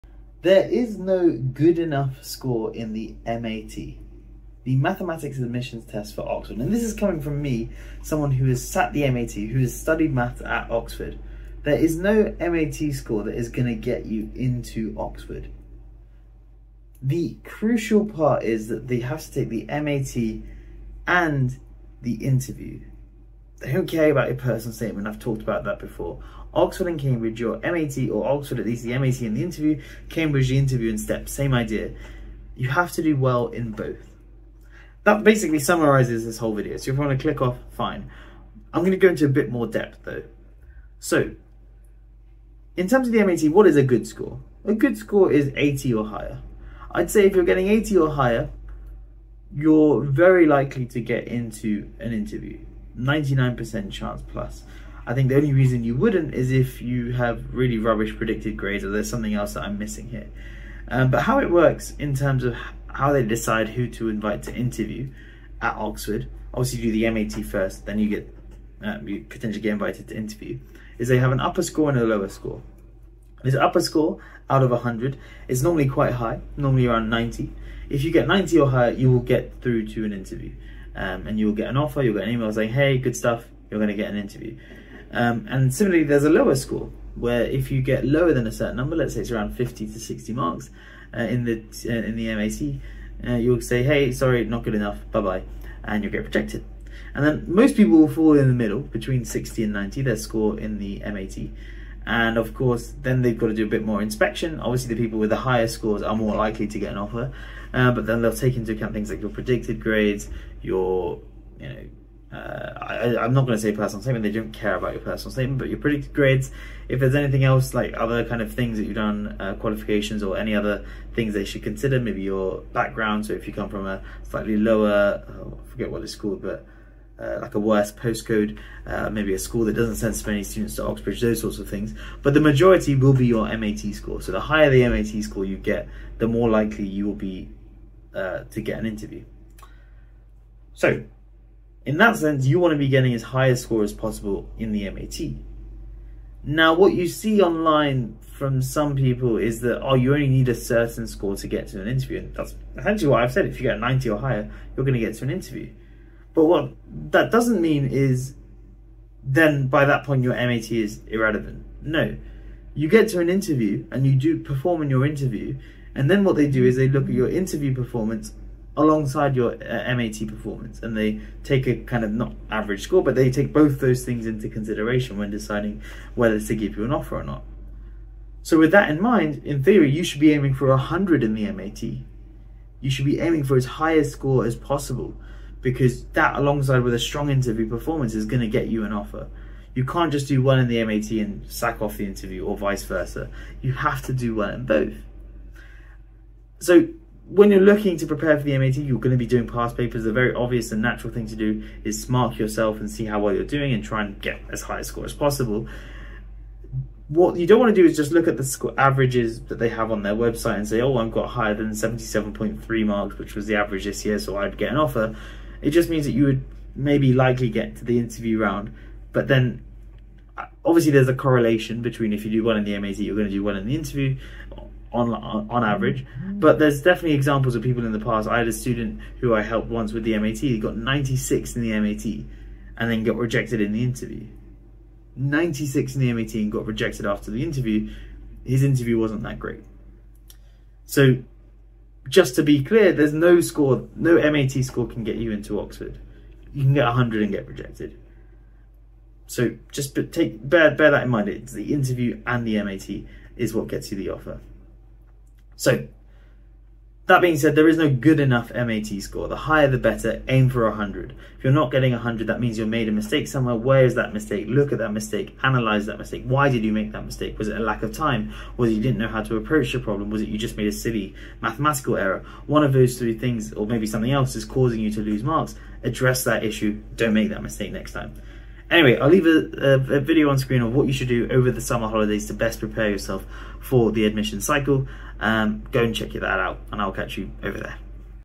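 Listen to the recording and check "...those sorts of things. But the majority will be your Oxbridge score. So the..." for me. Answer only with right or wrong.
wrong.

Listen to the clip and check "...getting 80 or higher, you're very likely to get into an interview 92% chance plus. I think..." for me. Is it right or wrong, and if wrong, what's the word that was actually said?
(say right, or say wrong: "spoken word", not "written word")
wrong: "99", not "92".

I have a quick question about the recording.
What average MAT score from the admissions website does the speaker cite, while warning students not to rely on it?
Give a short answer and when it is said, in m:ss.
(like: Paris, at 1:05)
77.3, at 3:31.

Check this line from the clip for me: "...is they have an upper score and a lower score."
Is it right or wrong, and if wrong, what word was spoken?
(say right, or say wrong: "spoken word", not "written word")
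right.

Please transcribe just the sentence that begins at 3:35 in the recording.
It just means that you would maybe likely get to the interview round.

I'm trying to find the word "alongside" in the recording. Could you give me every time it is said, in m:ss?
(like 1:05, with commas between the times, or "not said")
2:48, 3:06.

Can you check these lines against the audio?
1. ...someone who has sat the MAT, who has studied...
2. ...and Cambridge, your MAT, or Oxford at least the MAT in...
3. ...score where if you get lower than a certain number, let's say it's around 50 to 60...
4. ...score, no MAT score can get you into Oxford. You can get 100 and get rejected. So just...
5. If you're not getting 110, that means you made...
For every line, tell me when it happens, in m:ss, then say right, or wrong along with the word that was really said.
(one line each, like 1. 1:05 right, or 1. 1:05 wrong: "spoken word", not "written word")
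1. 0:08 right
2. 0:26 right
3. 1:26 right
4. 4:03 right
5. 4:21 wrong: "100", not "110".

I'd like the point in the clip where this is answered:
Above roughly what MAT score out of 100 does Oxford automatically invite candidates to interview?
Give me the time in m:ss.
1:16.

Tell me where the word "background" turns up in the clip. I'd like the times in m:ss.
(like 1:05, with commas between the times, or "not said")
2:02.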